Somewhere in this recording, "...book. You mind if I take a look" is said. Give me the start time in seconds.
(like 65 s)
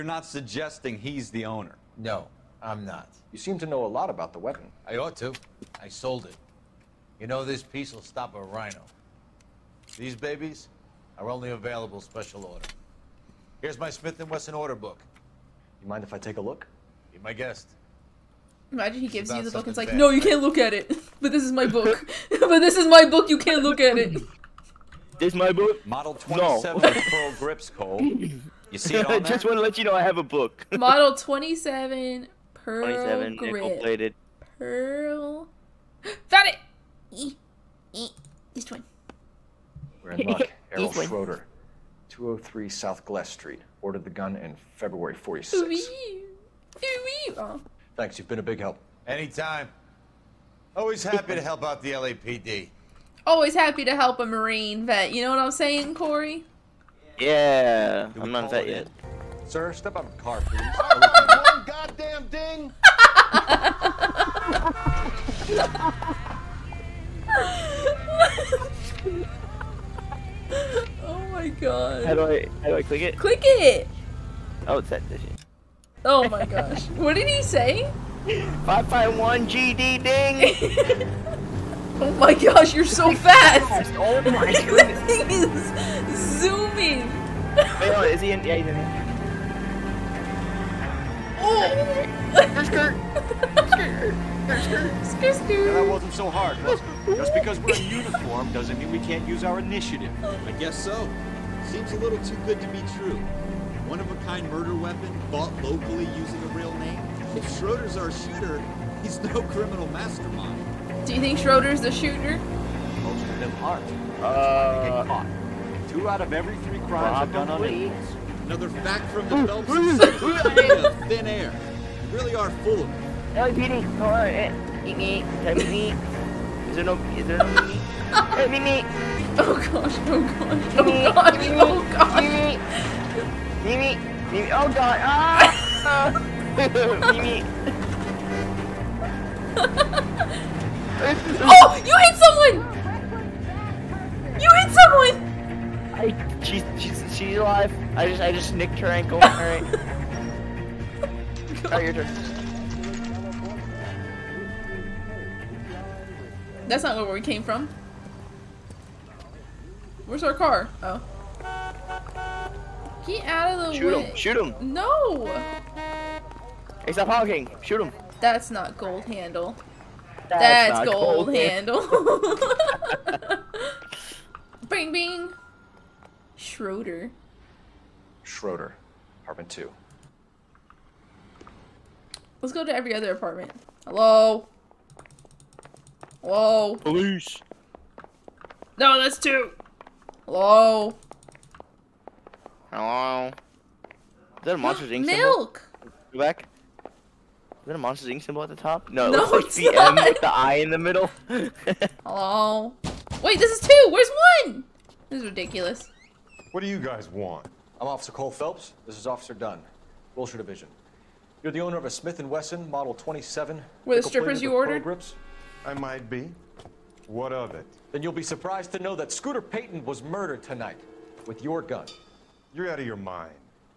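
14 s.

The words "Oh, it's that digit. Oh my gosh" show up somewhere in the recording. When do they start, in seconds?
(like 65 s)
74 s.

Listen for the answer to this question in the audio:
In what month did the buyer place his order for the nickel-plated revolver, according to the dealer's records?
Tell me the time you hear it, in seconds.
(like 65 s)
44 s.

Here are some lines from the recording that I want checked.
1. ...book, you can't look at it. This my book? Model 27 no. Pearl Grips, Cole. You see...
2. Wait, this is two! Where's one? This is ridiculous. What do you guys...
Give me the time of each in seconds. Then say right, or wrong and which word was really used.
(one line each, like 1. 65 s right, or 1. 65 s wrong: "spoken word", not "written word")
1. 23 s right
2. 203 s right.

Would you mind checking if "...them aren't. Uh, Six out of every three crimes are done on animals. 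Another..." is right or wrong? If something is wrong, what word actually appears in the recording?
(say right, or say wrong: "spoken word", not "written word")
wrong: "Two", not "Six".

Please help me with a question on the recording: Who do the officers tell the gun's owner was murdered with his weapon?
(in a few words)
Scooter Payton.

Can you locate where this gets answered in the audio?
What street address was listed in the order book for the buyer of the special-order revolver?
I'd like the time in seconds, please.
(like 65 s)
42 s.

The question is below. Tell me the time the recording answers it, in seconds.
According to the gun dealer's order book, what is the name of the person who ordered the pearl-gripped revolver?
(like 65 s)
40 s.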